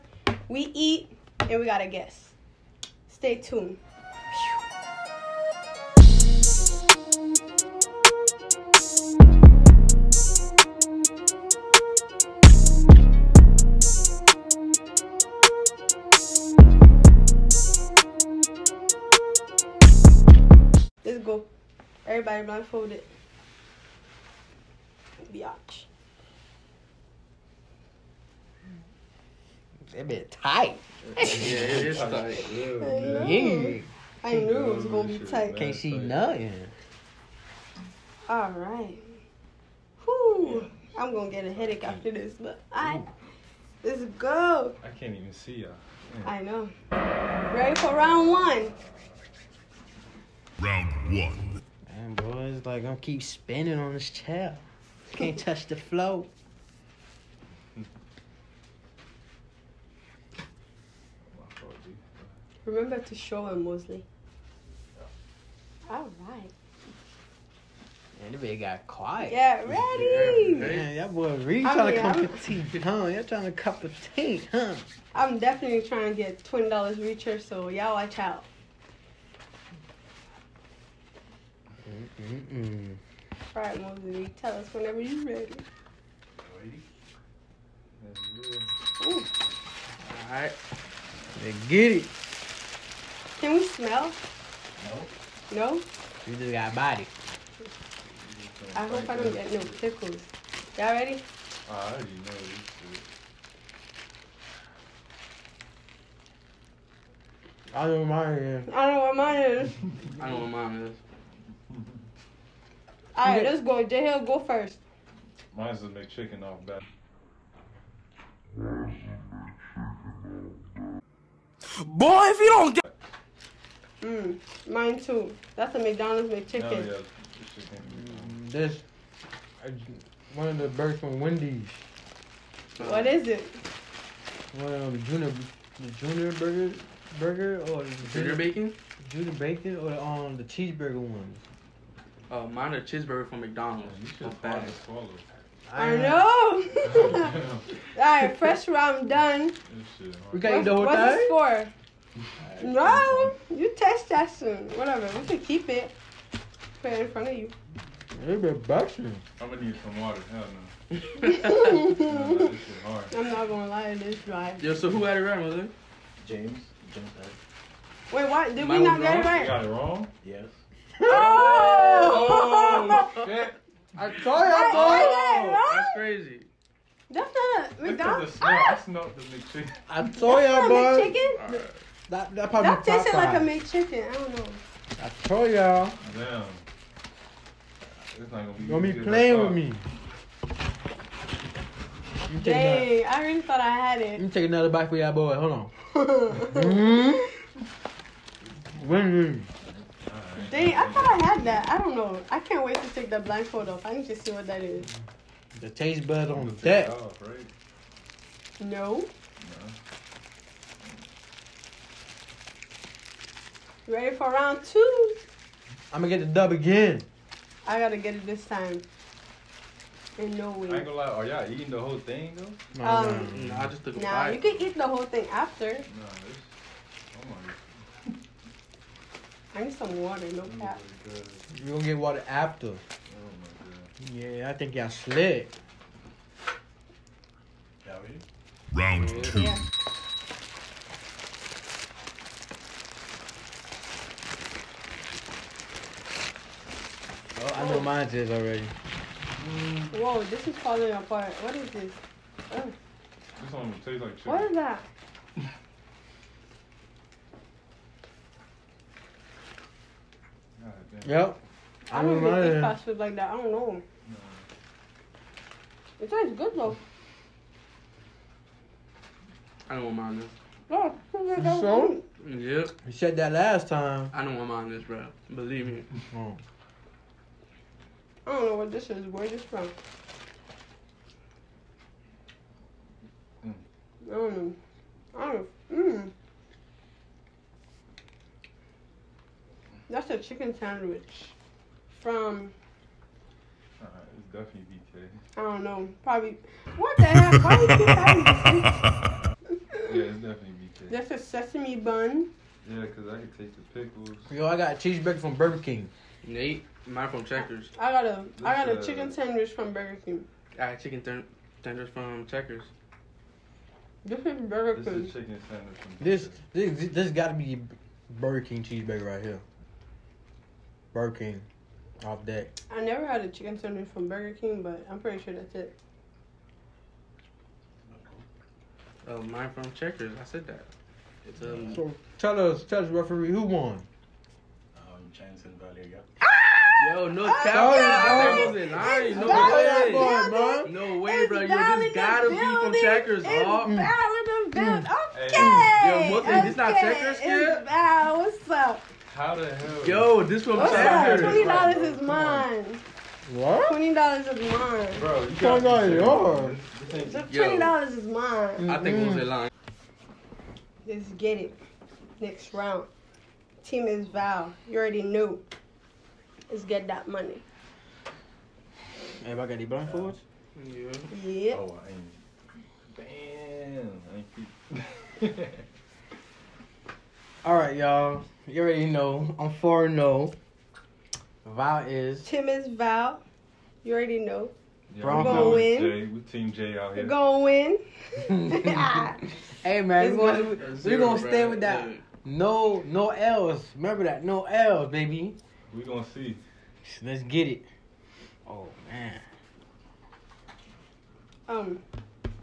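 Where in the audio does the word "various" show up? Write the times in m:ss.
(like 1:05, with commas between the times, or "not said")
not said.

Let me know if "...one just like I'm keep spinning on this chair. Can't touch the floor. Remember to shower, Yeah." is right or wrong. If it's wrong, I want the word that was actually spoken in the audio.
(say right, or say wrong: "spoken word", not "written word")
wrong: "Mosley", not "Yeah".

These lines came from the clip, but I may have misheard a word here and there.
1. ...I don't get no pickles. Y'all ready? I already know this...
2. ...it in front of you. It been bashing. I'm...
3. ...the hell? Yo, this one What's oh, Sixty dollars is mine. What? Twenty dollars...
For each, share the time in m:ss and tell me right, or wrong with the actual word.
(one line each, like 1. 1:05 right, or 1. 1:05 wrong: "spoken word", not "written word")
1. 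1:39 right
2. 2:36 right
3. 5:49 wrong: "Twenty", not "Sixty".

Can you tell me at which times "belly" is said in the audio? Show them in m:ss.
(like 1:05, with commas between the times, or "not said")
not said.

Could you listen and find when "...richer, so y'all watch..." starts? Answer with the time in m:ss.
1:16.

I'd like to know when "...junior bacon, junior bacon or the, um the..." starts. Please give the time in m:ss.
2:18.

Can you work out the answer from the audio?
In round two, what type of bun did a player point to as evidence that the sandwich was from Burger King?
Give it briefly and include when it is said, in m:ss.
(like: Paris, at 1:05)
Sesame bun, at 5:01.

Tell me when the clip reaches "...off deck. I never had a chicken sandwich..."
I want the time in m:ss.
5:22.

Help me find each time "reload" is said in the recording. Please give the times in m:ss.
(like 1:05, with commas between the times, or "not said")
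not said.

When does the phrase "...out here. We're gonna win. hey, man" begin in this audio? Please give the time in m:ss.
6:26.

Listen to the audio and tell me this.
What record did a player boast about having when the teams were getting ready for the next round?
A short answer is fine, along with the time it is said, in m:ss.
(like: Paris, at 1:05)
4-0, at 6:19.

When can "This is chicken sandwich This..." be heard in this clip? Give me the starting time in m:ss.
5:14.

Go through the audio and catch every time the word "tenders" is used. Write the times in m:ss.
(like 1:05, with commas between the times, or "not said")
5:11.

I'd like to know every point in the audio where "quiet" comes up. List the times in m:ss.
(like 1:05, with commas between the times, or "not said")
1:08.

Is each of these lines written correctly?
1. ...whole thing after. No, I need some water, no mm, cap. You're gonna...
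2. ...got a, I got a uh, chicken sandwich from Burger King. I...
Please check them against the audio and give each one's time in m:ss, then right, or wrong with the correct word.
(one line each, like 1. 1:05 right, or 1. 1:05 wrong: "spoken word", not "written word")
1. 3:44 right
2. 5:07 right.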